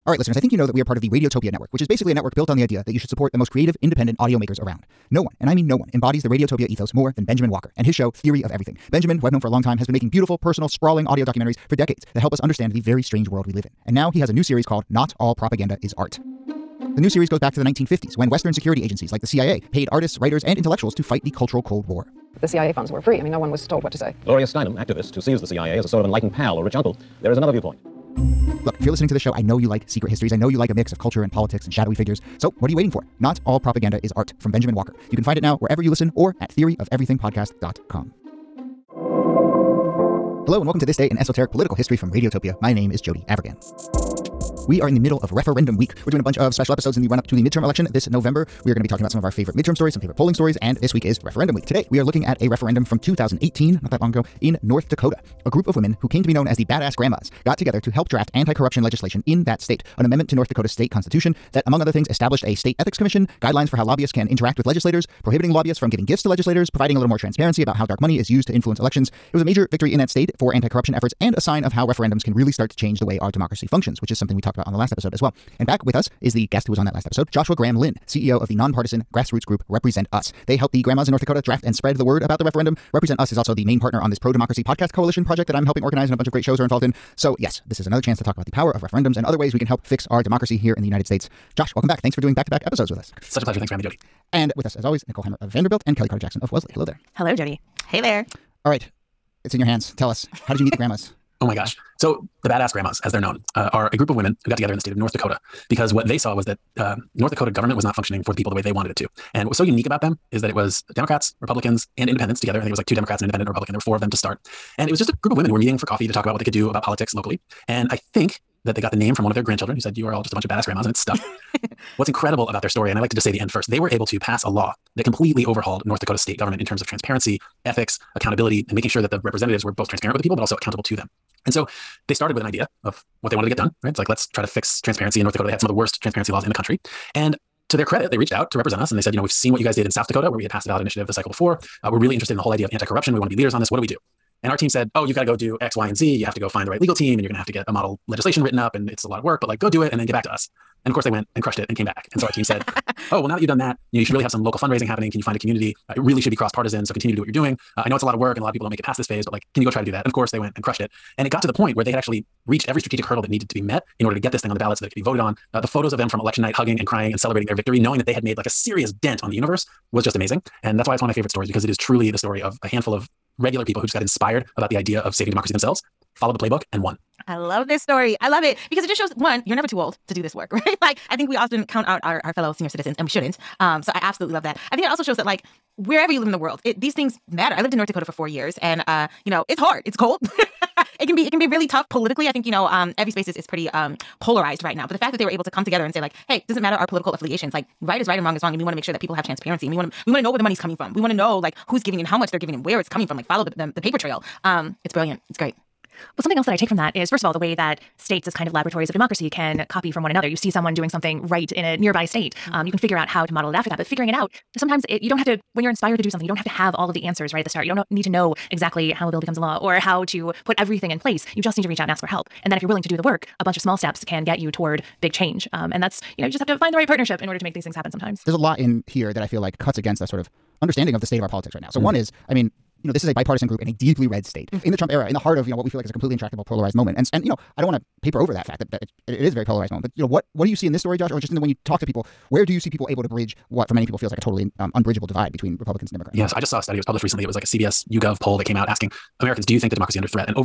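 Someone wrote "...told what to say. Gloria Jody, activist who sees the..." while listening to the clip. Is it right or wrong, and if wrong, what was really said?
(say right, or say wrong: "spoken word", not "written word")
wrong: "Steinem", not "Jody".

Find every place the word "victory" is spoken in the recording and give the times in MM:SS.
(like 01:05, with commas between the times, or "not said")
01:09, 02:47.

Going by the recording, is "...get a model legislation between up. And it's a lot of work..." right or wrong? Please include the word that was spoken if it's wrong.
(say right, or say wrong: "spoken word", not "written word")
wrong: "written", not "between".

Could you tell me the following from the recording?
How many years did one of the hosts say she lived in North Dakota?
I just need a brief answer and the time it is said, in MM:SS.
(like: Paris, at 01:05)
4, at 03:08.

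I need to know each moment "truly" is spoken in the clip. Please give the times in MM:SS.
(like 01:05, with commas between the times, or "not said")
02:51.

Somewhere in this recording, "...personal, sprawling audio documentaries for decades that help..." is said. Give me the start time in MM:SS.
00:10.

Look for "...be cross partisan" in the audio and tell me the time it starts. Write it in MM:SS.
02:36.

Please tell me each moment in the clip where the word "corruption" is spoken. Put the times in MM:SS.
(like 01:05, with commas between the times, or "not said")
00:58, 01:10, 02:22.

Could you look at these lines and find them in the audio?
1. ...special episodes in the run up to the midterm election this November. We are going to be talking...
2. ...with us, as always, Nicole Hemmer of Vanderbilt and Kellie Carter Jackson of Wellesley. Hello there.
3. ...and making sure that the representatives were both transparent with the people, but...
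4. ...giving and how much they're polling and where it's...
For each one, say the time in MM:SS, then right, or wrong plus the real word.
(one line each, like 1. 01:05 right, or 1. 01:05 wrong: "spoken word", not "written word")
1. 00:46 right
2. 01:34 right
3. 02:08 right
4. 03:21 wrong: "giving", not "polling".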